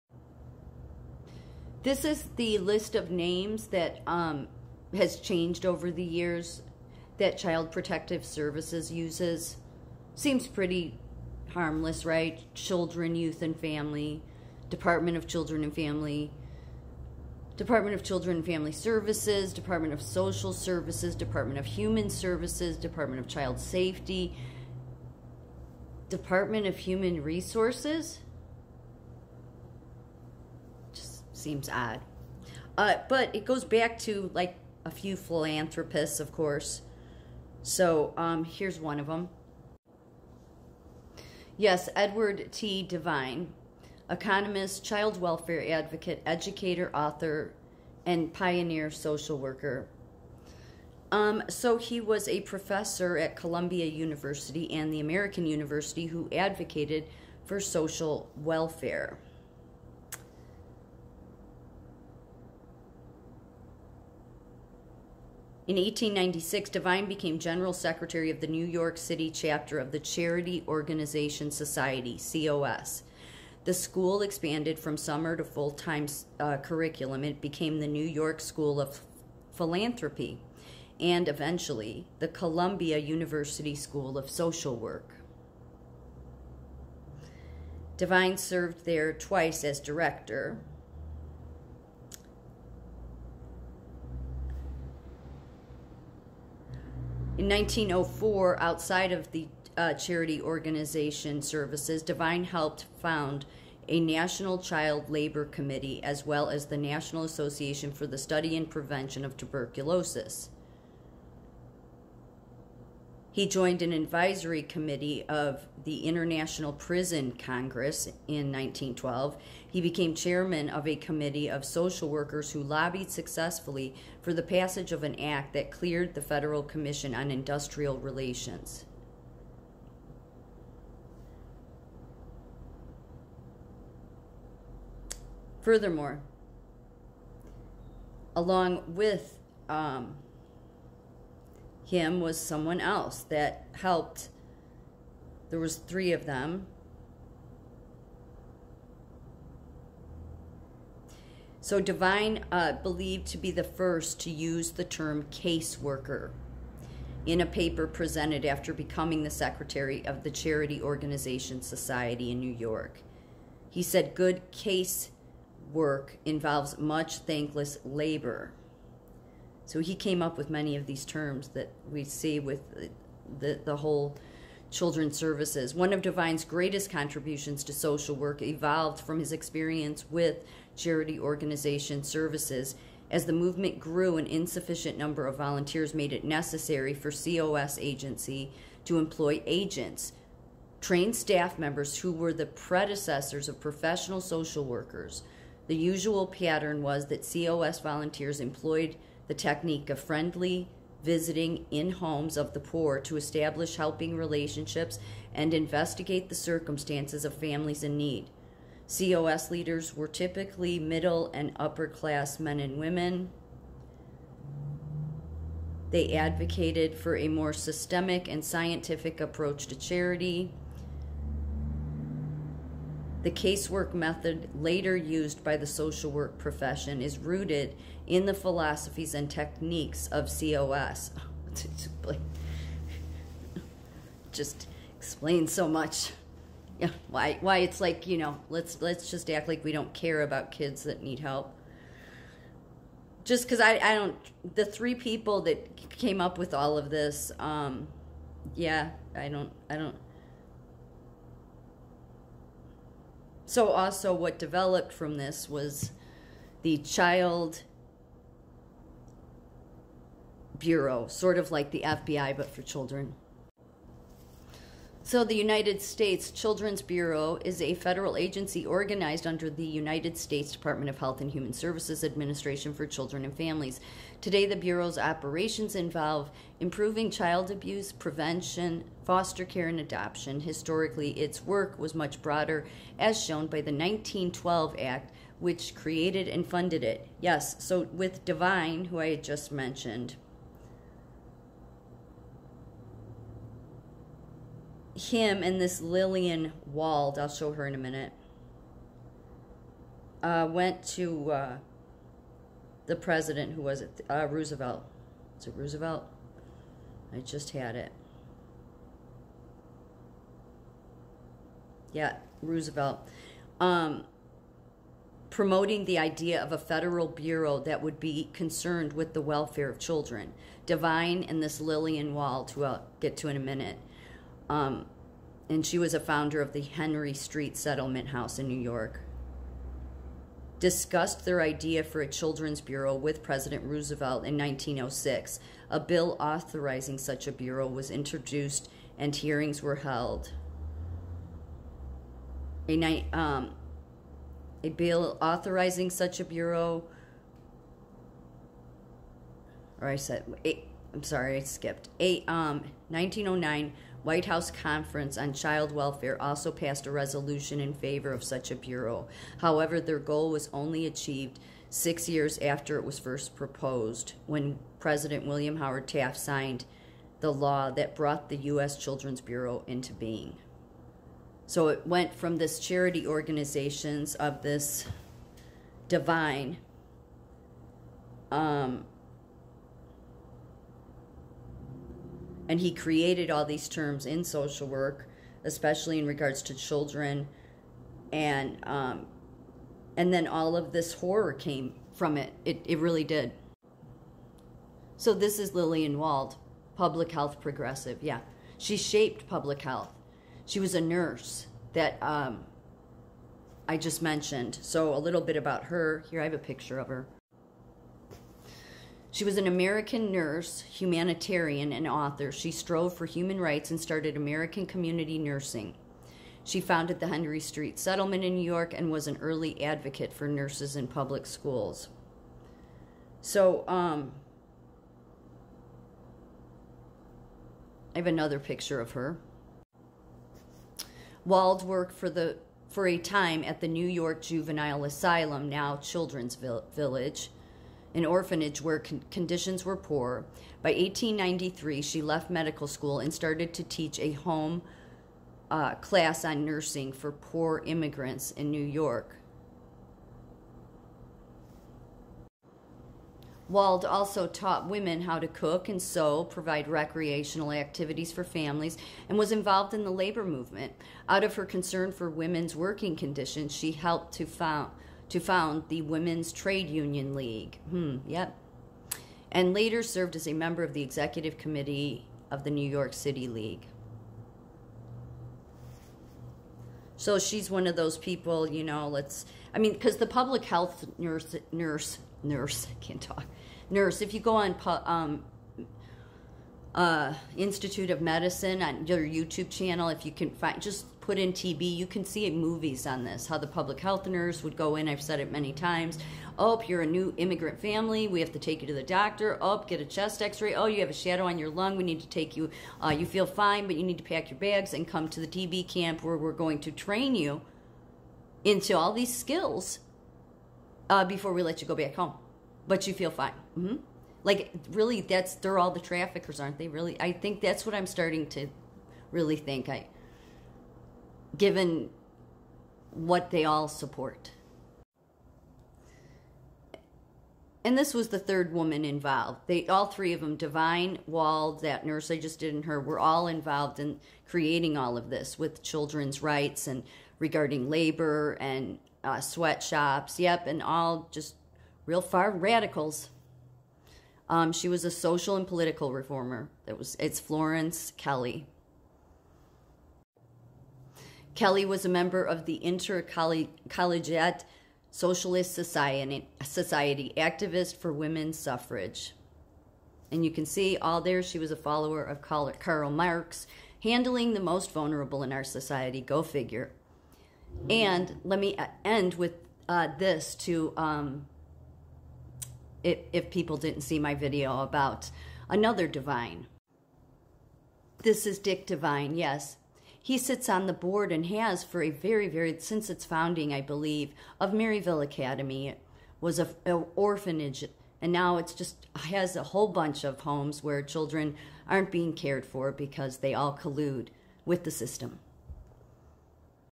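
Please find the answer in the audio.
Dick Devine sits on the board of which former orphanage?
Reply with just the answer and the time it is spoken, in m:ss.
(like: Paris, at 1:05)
Maryville Academy, at 9:44.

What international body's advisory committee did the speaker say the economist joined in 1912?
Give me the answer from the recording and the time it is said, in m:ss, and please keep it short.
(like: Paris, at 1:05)
International Prison Congress, at 1:56.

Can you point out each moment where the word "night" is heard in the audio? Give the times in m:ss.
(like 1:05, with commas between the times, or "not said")
5:42.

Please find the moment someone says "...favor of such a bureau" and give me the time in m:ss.
5:57.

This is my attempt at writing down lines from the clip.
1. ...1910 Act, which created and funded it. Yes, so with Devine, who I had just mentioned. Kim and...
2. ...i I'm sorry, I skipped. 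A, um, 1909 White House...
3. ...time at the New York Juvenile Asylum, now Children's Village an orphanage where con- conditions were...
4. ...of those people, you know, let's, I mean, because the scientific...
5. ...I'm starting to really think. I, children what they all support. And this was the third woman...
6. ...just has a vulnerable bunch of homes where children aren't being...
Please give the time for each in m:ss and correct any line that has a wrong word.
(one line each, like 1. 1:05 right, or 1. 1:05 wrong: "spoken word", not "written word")
1. 4:43 wrong: "1912", not "1910"
2. 5:50 right
3. 7:12 right
4. 7:57 wrong: "public", not "scientific"
5. 8:37 wrong: "given", not "children"
6. 9:48 wrong: "whole", not "vulnerable".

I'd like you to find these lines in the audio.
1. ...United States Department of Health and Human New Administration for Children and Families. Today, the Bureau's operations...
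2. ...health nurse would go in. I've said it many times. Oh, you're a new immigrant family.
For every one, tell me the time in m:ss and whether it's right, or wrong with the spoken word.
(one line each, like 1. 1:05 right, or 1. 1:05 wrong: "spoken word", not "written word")
1. 4:29 wrong: "Services", not "New"
2. 8:13 right.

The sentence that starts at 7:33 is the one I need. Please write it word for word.
Wald also taught women how to cook and sew, provide recreational activities for families, and was involved in the labor movement.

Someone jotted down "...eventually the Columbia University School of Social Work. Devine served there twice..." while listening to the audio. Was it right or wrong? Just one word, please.
right.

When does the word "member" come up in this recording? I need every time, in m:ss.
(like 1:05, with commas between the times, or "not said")
3:11, 7:50, 9:11.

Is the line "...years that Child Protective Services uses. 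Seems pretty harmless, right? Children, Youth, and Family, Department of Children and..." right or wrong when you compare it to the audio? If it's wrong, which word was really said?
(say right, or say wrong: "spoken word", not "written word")
right.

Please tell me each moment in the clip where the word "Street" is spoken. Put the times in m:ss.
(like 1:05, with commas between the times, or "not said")
5:27, 6:57.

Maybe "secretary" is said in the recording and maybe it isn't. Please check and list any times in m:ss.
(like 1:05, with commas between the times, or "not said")
1:07, 2:39.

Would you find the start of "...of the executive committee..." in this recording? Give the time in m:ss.
7:50.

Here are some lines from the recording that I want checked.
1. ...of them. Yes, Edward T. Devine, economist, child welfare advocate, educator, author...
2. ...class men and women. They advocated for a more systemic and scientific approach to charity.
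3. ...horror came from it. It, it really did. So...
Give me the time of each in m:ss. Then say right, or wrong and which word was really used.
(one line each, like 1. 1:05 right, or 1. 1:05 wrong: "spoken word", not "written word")
1. 0:38 right
2. 3:31 right
3. 6:30 right.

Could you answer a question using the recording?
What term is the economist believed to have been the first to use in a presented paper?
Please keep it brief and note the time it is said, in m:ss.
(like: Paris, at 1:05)
caseworker, at 2:35.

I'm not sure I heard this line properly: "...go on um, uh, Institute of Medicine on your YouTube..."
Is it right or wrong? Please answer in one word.
right.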